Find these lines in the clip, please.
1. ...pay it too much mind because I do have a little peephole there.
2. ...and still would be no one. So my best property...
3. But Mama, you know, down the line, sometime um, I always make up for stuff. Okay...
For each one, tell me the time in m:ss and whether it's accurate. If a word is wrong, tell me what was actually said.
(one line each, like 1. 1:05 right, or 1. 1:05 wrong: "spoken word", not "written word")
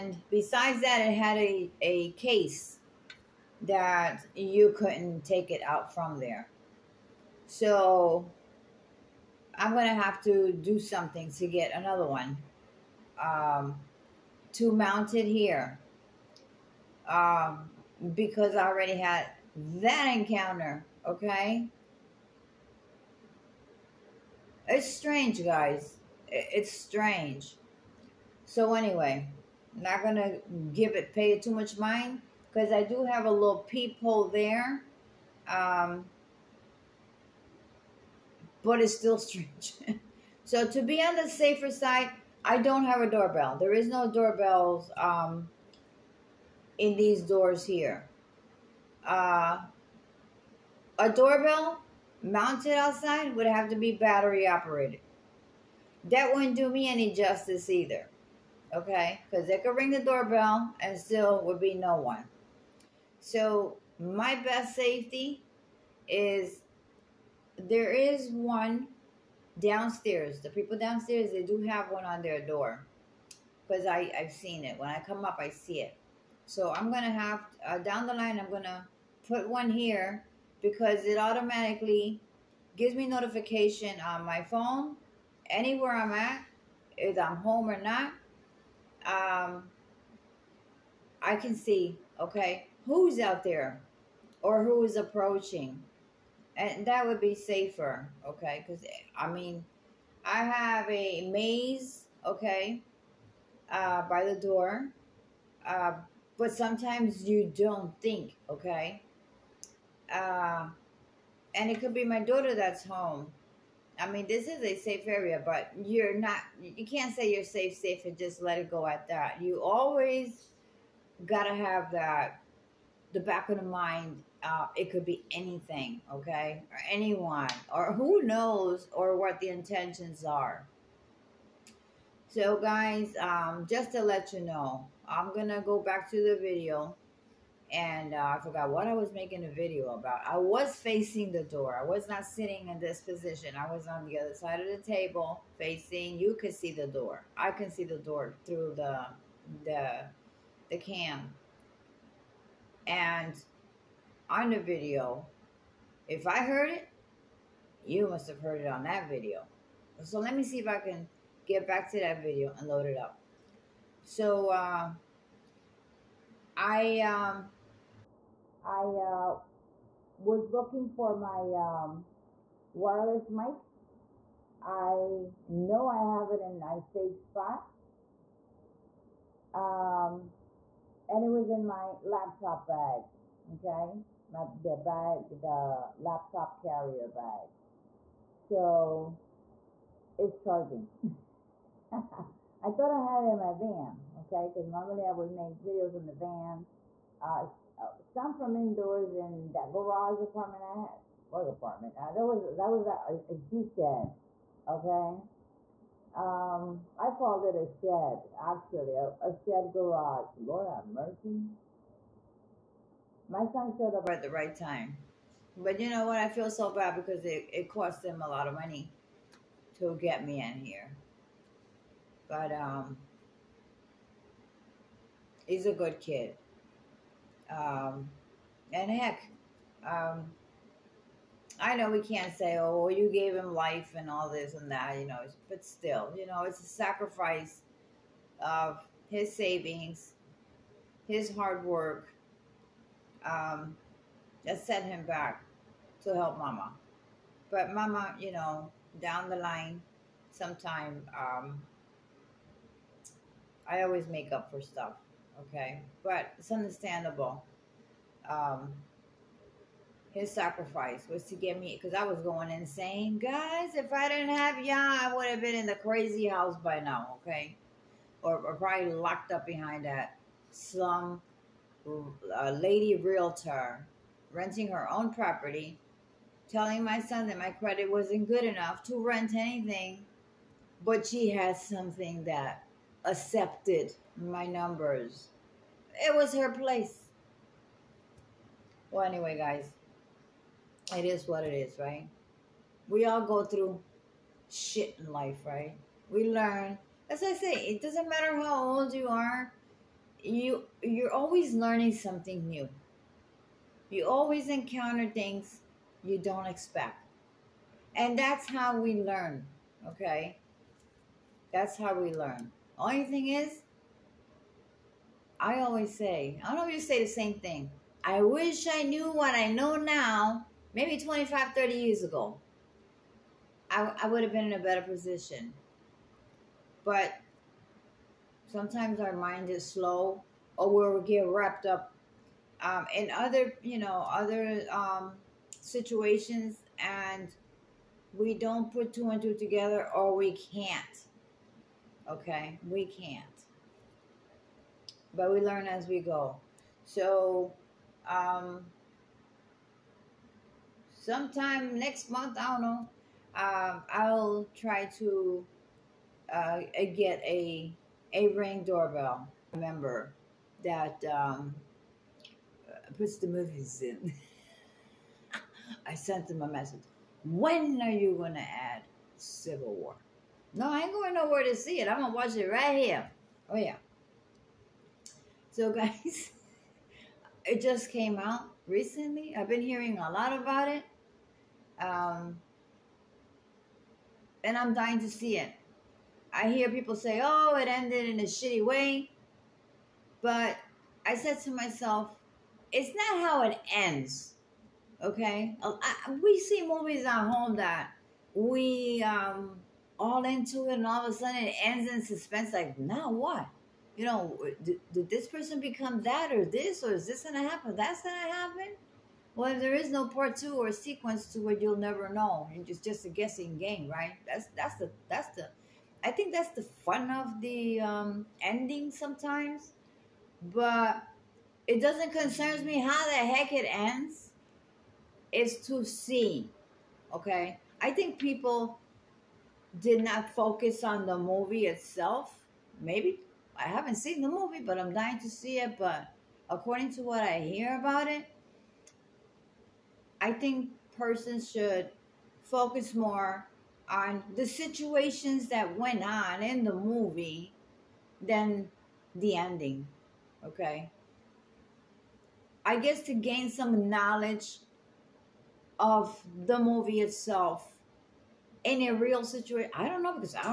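1. 0:31 right
2. 1:00 wrong: "safety", not "property"
3. 4:07 right.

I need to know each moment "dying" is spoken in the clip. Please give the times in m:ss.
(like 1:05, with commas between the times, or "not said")
6:24, 7:14.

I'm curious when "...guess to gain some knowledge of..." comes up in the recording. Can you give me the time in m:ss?
7:32.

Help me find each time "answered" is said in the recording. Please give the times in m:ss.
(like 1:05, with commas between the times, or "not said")
not said.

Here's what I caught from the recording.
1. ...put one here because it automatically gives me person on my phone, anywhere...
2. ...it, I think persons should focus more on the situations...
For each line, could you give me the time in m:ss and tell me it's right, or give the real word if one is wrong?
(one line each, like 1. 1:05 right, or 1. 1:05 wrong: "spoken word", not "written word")
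1. 1:19 wrong: "notification", not "person"
2. 7:18 right.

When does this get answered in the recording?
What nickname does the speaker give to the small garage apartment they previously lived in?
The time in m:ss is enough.
3:23.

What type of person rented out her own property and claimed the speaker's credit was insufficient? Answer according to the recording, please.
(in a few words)
lady realtor.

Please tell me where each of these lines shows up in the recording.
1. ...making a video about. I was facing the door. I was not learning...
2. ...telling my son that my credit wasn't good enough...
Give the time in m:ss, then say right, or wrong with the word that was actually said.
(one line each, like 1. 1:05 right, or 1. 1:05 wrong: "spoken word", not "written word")
1. 2:19 wrong: "sitting", not "learning"
2. 4:36 right.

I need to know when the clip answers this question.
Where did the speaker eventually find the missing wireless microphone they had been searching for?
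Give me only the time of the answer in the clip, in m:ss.
3:02.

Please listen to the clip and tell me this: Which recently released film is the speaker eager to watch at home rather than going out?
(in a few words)
Civil War.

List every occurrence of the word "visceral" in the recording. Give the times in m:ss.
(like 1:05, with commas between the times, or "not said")
not said.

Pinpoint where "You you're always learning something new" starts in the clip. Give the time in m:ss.
5:00.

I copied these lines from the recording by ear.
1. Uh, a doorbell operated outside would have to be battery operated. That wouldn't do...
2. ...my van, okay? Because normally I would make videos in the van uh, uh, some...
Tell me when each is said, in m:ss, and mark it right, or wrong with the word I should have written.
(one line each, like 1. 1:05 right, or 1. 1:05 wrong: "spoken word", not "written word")
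1. 0:49 wrong: "mounted", not "operated"
2. 3:13 right.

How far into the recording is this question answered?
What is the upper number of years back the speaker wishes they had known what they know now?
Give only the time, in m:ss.
5:21.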